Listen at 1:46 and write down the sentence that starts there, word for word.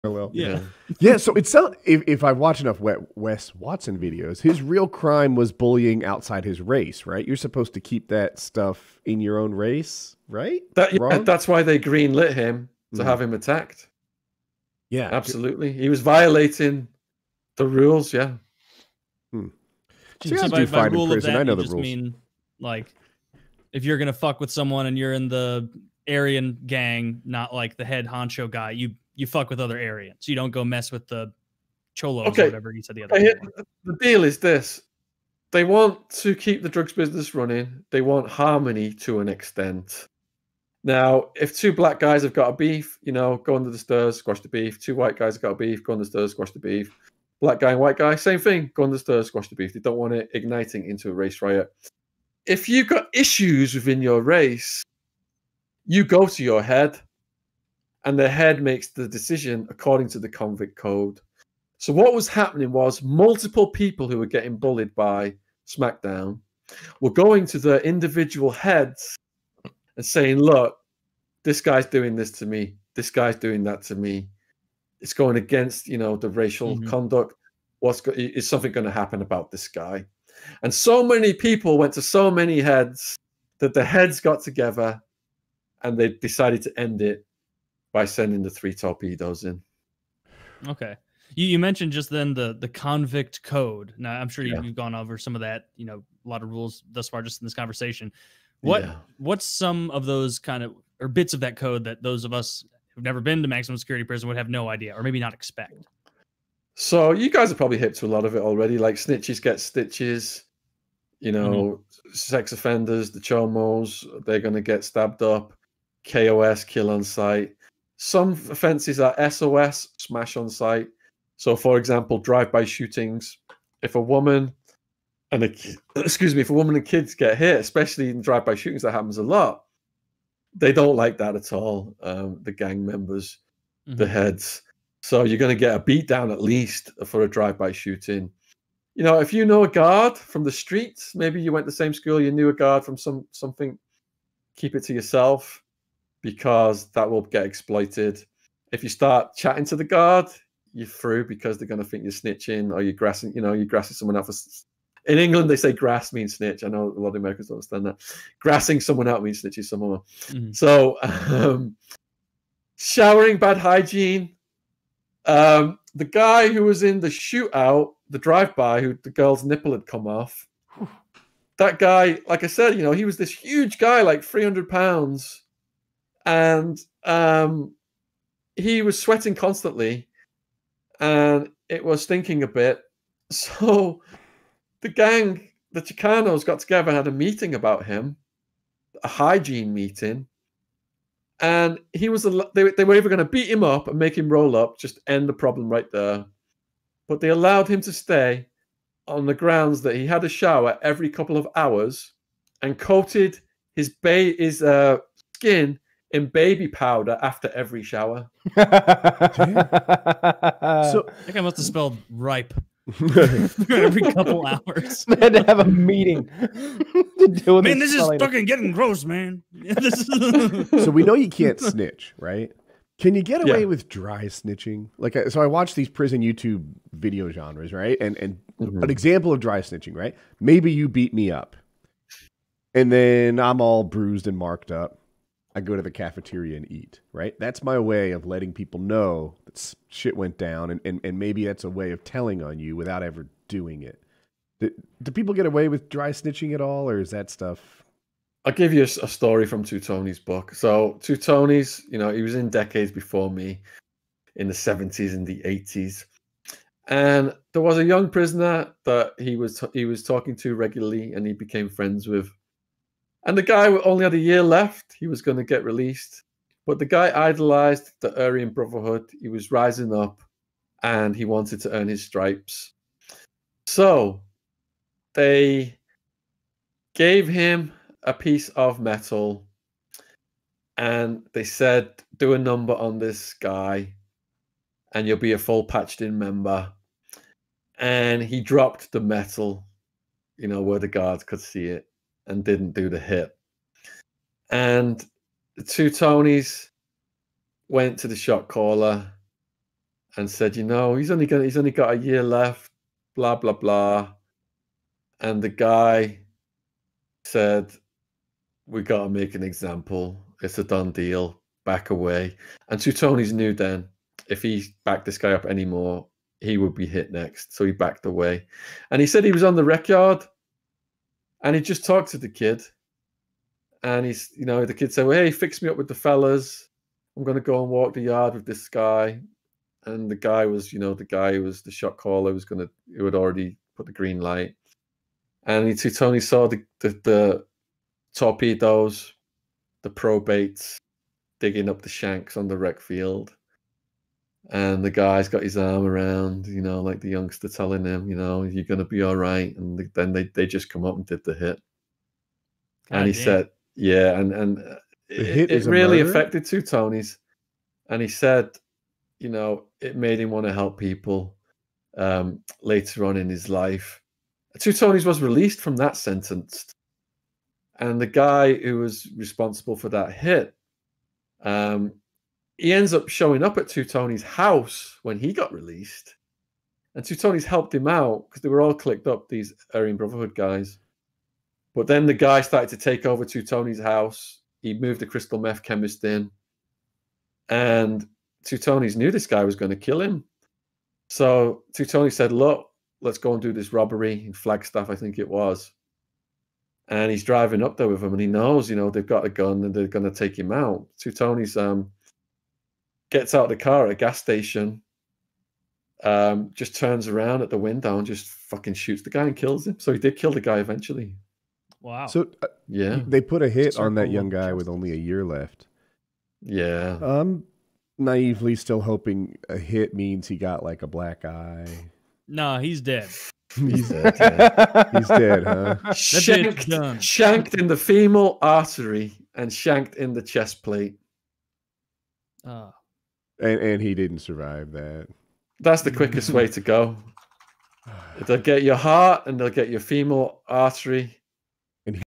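So you guys are probably hip to a lot of it already.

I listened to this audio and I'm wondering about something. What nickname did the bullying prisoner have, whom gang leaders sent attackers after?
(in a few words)
SmackDown.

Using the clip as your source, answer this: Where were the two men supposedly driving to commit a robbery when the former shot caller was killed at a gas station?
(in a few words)
Flagstaff.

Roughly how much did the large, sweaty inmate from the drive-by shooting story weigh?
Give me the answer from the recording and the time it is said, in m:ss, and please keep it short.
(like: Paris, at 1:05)
300 pounds, at 2:54.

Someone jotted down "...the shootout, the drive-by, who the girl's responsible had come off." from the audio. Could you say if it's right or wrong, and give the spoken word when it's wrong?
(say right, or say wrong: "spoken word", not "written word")
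wrong: "nipple", not "responsible".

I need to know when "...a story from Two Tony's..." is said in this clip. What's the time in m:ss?
4:09.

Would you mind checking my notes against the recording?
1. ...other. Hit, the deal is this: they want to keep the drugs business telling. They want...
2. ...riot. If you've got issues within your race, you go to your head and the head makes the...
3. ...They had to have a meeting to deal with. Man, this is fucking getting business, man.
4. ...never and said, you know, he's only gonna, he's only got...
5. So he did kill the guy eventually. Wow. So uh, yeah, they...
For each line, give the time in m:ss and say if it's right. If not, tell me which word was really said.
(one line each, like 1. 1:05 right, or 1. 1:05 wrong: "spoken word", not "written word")
1. 0:33 wrong: "running", not "telling"
2. 0:51 right
3. 3:35 wrong: "gross", not "business"
4. 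4:58 wrong: "caller", not "never"
5. 6:49 right.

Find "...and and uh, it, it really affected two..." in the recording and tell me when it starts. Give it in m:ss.
5:54.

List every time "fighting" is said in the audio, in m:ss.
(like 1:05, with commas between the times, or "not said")
not said.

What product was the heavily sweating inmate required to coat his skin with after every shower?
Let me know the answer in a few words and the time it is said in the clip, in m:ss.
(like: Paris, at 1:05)
Baby powder, at 3:26.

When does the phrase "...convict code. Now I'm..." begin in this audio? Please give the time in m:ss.
1:32.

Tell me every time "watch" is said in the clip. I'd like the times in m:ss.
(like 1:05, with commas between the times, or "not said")
0:02, 3:45.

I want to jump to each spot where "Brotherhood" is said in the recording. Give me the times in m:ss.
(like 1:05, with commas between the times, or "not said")
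4:28, 6:19.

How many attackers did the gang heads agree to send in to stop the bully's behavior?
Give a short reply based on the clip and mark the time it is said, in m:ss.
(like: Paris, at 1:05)
3, at 1:28.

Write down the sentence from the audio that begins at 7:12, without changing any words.
Oh and and he didn't survive that.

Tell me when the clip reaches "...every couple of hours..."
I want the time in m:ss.
3:20.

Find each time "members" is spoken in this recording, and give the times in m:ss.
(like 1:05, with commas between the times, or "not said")
2:12, 4:46.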